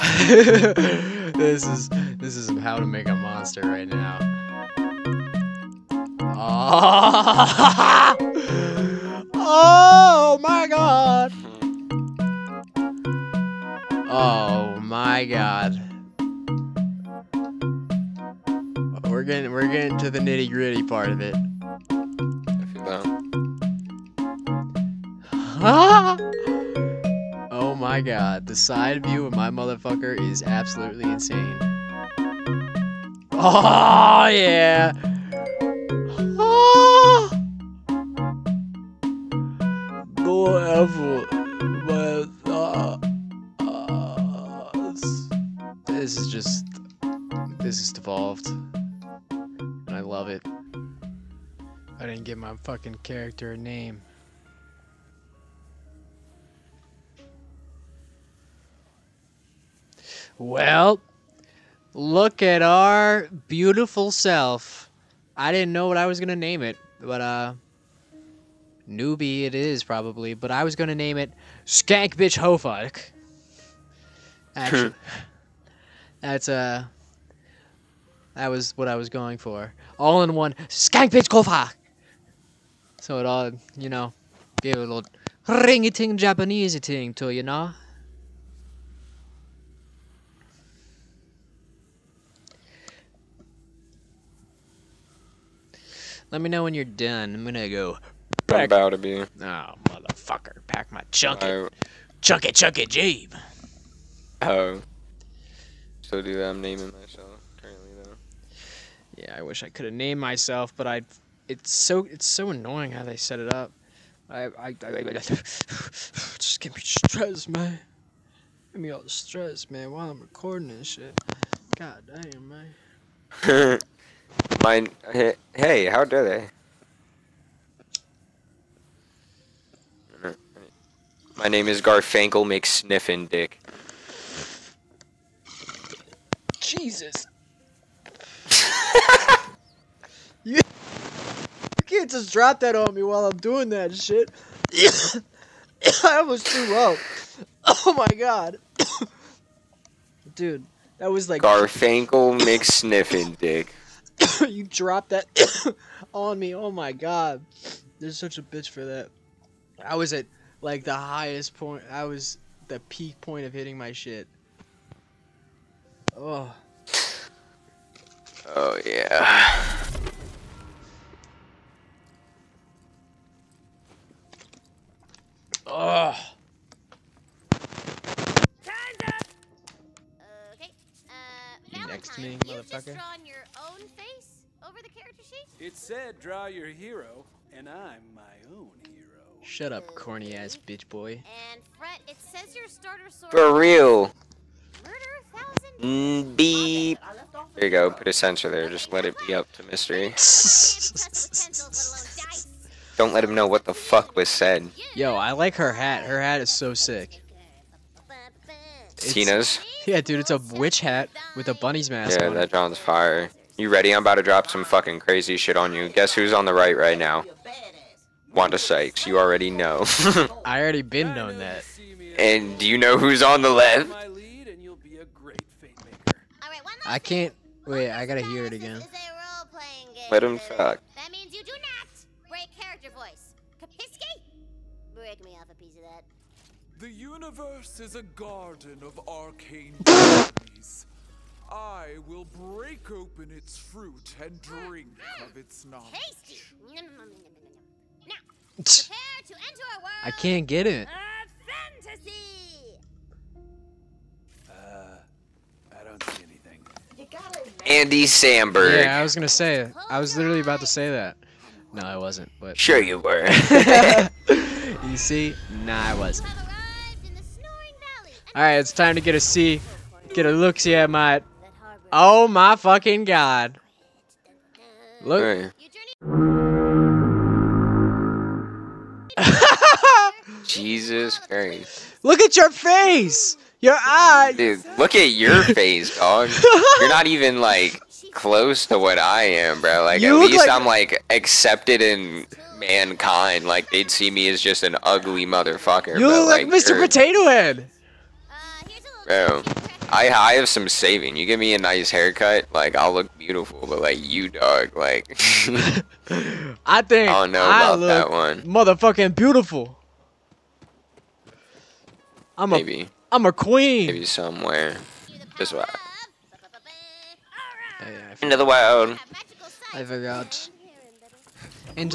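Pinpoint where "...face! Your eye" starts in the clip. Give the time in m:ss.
4:42.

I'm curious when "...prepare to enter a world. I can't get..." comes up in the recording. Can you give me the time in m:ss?
4:08.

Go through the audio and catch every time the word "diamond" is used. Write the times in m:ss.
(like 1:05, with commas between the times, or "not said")
not said.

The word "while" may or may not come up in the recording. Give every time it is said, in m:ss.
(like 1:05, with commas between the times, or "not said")
1:59, 2:23.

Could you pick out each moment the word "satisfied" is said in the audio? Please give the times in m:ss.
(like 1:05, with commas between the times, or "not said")
not said.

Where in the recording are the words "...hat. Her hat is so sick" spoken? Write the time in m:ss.
3:25.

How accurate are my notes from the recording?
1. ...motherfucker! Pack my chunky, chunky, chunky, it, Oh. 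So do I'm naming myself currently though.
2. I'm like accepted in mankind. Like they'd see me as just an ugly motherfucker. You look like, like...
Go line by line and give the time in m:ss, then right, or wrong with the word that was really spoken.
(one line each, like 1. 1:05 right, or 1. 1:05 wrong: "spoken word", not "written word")
1. 1:39 right
2. 4:50 right.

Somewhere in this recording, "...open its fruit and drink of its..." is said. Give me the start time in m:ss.
4:02.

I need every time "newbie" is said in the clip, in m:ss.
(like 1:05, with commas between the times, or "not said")
1:08.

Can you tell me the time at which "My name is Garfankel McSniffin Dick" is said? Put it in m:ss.
2:11.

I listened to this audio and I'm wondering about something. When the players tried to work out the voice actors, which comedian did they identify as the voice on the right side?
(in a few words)
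Wanda Sykes.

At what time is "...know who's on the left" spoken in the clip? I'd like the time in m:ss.
3:42.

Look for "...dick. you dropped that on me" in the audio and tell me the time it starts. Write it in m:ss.
2:33.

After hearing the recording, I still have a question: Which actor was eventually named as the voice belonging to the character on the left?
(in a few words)
Andy Samberg.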